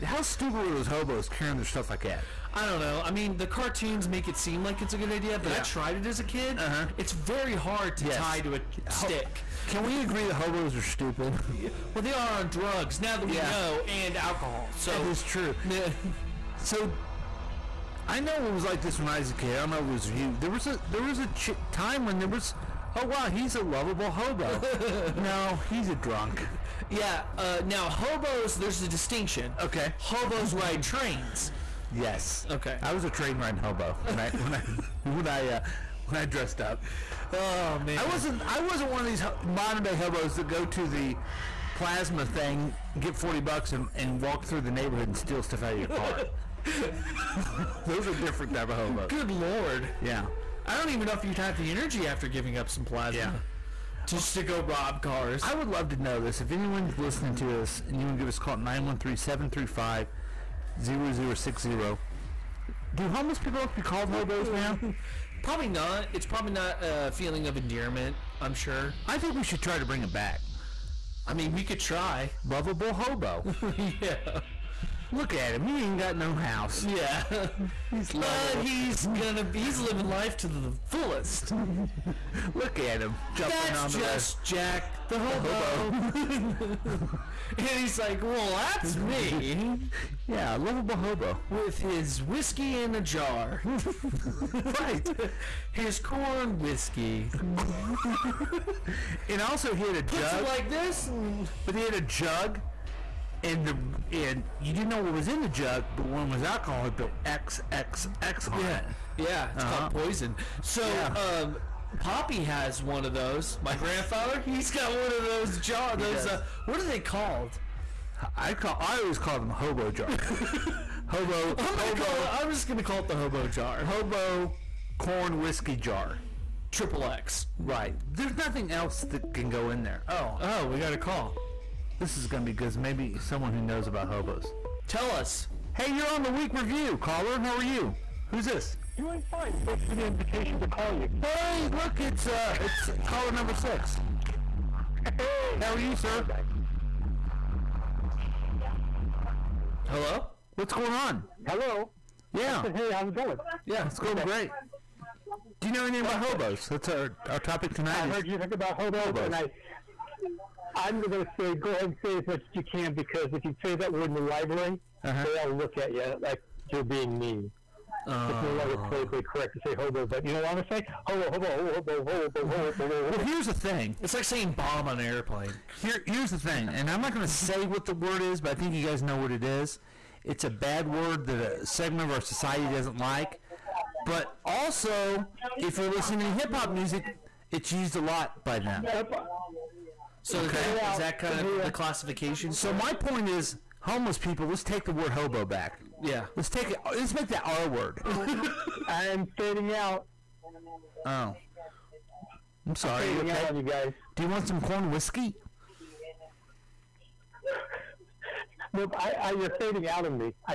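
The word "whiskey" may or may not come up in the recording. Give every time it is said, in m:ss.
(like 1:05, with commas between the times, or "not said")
1:32, 1:36, 2:05, 3:24.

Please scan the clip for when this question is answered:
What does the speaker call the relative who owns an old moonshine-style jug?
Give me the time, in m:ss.
1:52.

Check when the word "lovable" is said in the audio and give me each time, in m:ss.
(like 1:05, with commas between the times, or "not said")
0:23, 1:12, 1:30.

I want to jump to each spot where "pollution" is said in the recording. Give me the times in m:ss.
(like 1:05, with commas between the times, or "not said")
not said.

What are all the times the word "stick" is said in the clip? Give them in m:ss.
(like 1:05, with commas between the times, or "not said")
0:08.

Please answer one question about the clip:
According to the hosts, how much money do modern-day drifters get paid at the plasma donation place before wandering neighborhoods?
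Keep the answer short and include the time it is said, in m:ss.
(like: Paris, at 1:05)
$40, at 0:43.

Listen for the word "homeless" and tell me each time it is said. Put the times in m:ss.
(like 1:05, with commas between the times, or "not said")
1:03, 3:13.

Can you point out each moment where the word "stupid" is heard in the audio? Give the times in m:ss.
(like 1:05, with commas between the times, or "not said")
0:00, 0:10.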